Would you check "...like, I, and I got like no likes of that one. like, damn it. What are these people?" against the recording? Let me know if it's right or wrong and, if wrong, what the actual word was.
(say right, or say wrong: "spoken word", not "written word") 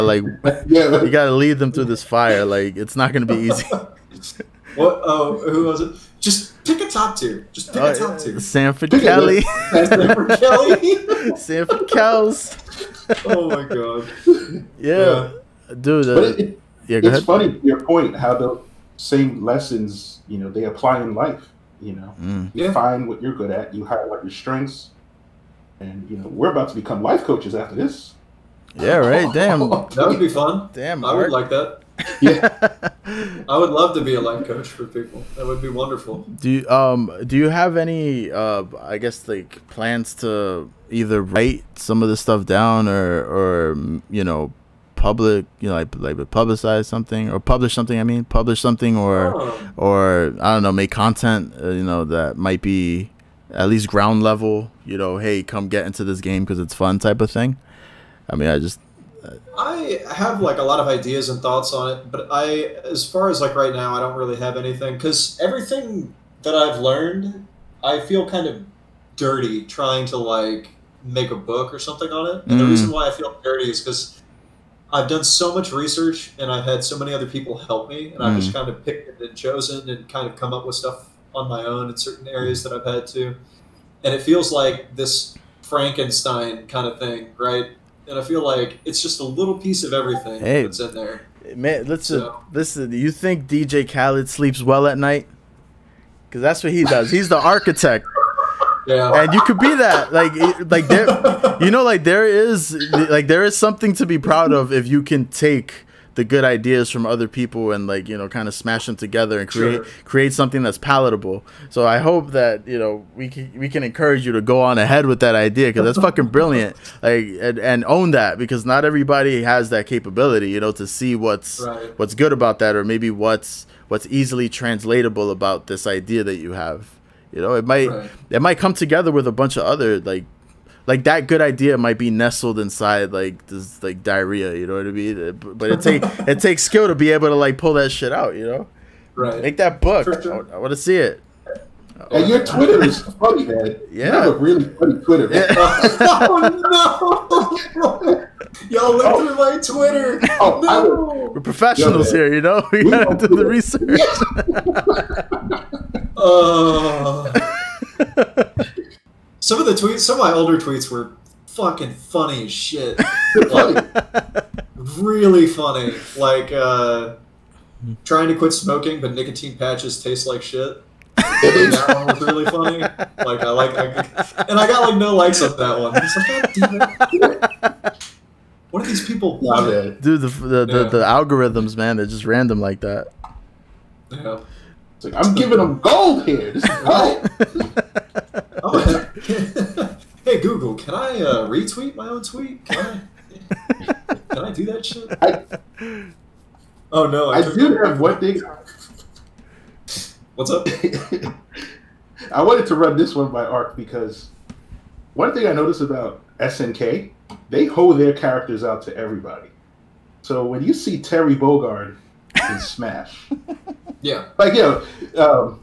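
right.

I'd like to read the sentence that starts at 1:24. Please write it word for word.
And it feels like this Frankenstein kind of thing, right?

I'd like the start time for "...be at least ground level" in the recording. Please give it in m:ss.
0:52.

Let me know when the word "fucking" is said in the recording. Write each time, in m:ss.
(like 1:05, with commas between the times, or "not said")
1:55, 2:41.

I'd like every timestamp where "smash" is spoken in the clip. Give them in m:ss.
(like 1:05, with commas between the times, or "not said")
1:48, 3:32.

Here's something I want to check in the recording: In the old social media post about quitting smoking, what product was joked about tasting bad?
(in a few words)
nicotine patches.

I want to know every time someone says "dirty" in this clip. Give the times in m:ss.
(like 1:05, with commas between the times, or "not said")
1:09, 1:13.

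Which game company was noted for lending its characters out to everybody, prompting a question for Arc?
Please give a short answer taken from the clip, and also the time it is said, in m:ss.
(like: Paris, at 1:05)
SNK, at 3:26.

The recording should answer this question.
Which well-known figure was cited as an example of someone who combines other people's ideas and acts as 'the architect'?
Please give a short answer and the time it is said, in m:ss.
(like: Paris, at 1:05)
DJ Khaled, at 1:33.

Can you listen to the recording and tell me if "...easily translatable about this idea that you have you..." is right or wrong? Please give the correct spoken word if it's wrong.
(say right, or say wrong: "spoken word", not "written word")
right.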